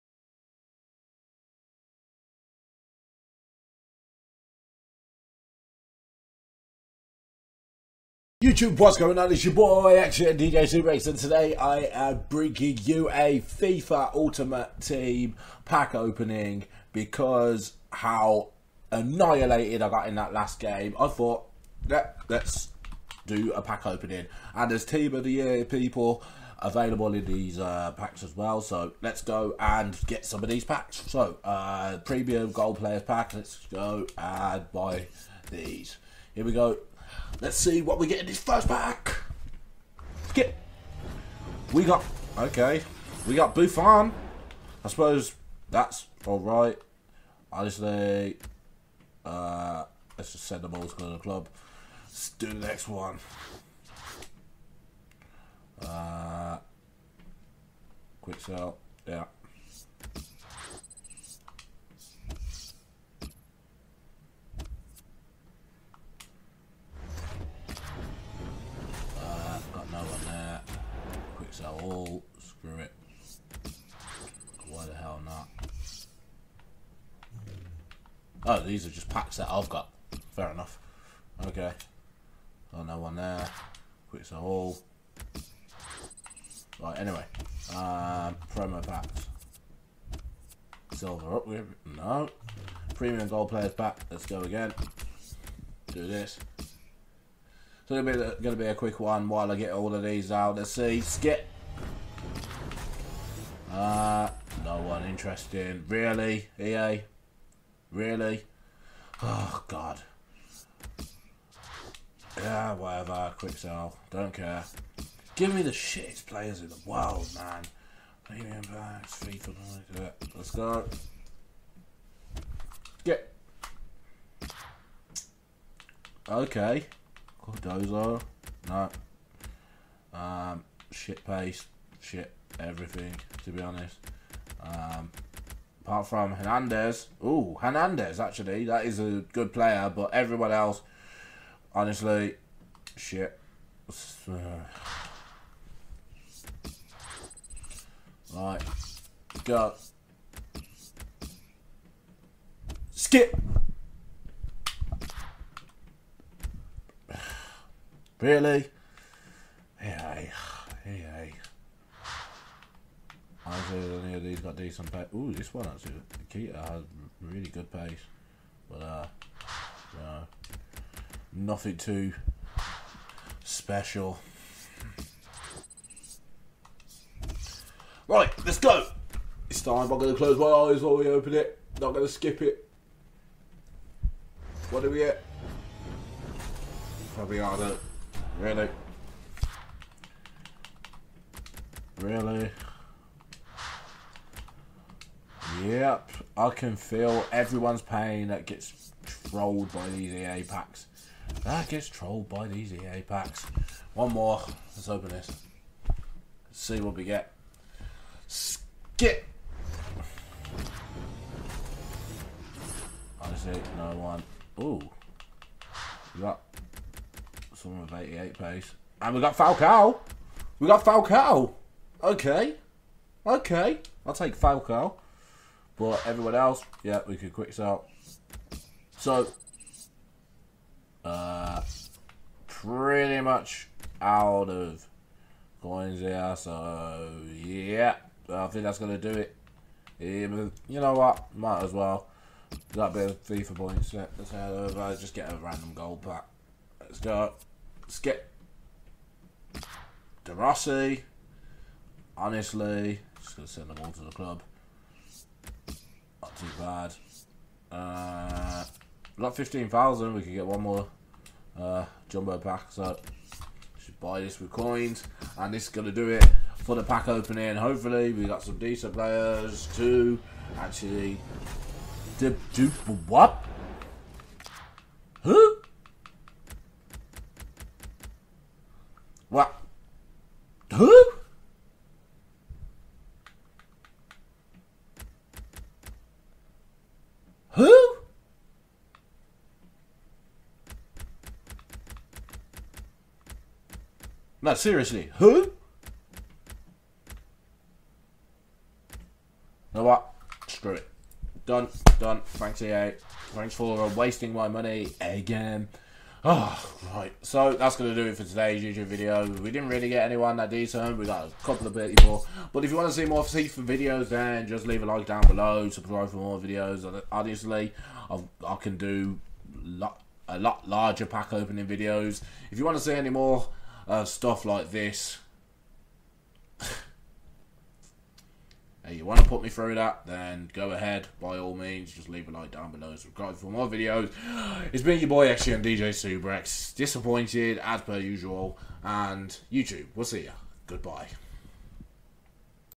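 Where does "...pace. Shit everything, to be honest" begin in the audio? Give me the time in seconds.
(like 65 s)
131 s.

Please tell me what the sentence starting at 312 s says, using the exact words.
But if you want to see more FIFA videos, then just leave a like down below.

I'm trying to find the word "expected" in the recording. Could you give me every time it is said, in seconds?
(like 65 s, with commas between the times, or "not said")
not said.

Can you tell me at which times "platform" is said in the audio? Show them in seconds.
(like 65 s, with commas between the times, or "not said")
not said.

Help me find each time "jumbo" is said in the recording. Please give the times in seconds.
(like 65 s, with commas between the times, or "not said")
262 s.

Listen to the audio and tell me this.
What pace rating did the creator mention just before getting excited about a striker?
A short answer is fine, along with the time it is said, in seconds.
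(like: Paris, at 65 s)
88, at 217 s.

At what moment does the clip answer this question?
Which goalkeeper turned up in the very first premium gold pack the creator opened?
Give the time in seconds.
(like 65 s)
43 s.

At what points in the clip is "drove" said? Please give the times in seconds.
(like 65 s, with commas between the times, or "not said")
not said.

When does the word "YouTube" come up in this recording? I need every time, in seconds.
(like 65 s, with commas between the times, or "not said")
8 s, 308 s, 339 s.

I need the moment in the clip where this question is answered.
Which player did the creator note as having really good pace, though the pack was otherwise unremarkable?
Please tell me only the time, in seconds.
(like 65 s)
166 s.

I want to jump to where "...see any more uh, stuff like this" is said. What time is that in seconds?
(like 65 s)
322 s.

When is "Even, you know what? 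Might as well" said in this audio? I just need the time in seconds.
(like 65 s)
239 s.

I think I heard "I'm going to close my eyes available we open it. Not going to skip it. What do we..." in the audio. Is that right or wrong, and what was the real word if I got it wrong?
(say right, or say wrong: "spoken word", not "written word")
wrong: "while", not "available".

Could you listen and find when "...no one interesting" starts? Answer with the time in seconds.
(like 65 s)
104 s.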